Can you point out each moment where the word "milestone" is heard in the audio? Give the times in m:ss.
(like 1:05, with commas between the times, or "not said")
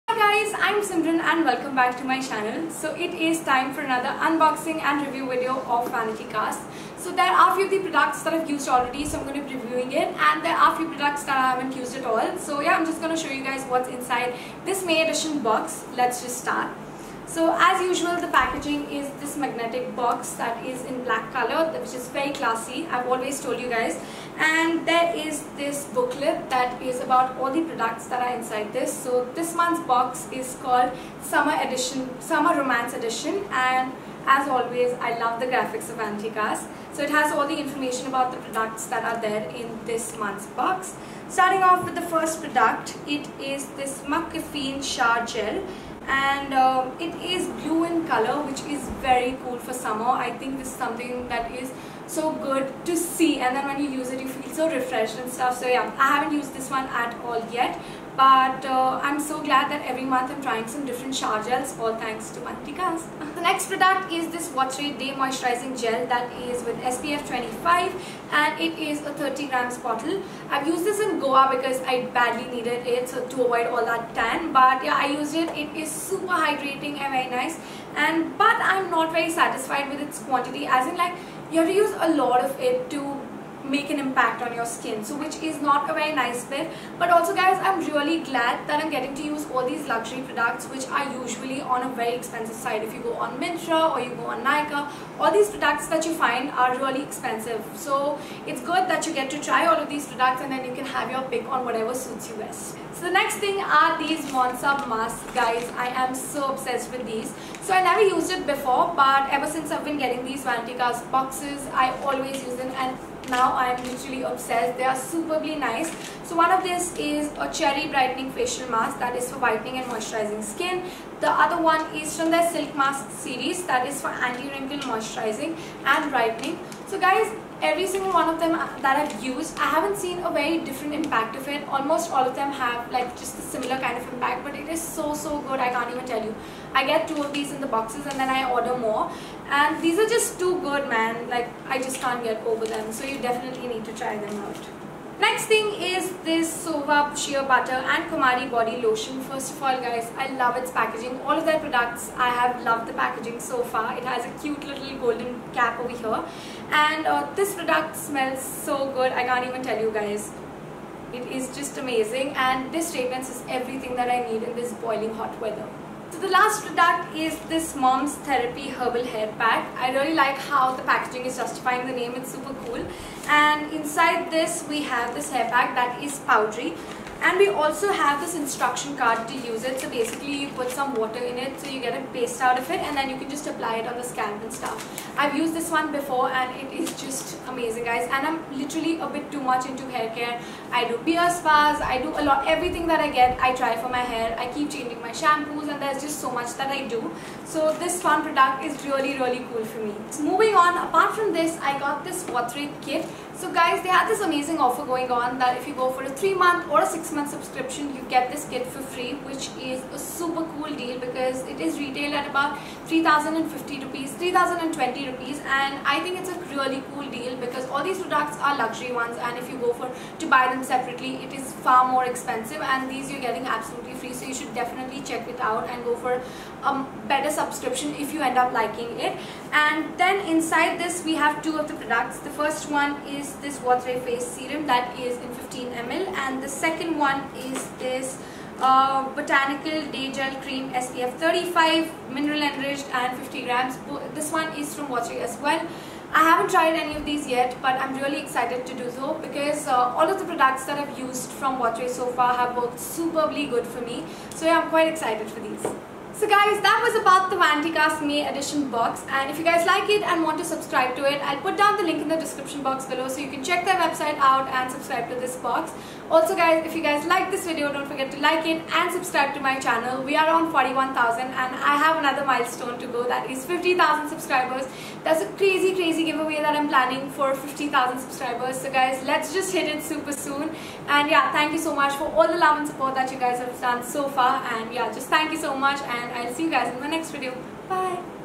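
4:32.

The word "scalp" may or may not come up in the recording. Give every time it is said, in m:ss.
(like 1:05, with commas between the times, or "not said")
3:04.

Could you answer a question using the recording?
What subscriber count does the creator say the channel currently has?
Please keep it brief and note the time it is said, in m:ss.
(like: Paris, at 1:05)
41,000, at 4:30.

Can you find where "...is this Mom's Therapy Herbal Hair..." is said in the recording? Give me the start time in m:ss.
2:47.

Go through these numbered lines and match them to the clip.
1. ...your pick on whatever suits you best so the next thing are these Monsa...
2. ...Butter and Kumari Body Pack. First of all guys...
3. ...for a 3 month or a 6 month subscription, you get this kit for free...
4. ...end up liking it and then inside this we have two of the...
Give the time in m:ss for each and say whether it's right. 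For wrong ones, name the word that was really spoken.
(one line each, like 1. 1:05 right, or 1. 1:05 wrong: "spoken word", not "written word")
1. 1:41 right
2. 2:27 wrong: "Lotion", not "Pack"
3. 3:25 right
4. 3:48 right.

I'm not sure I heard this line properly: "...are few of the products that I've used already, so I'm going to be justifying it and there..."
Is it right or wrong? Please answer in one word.
wrong.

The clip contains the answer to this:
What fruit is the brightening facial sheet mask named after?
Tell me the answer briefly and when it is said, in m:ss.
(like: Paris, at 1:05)
Cherry, at 1:57.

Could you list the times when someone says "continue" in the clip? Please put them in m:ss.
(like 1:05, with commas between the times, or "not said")
not said.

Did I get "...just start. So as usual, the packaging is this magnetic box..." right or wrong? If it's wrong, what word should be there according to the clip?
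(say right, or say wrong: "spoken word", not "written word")
right.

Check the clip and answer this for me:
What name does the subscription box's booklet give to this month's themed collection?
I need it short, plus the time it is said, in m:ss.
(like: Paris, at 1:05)
Summer Romance Edition, at 0:32.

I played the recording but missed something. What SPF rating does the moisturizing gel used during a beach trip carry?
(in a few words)
SPF 25.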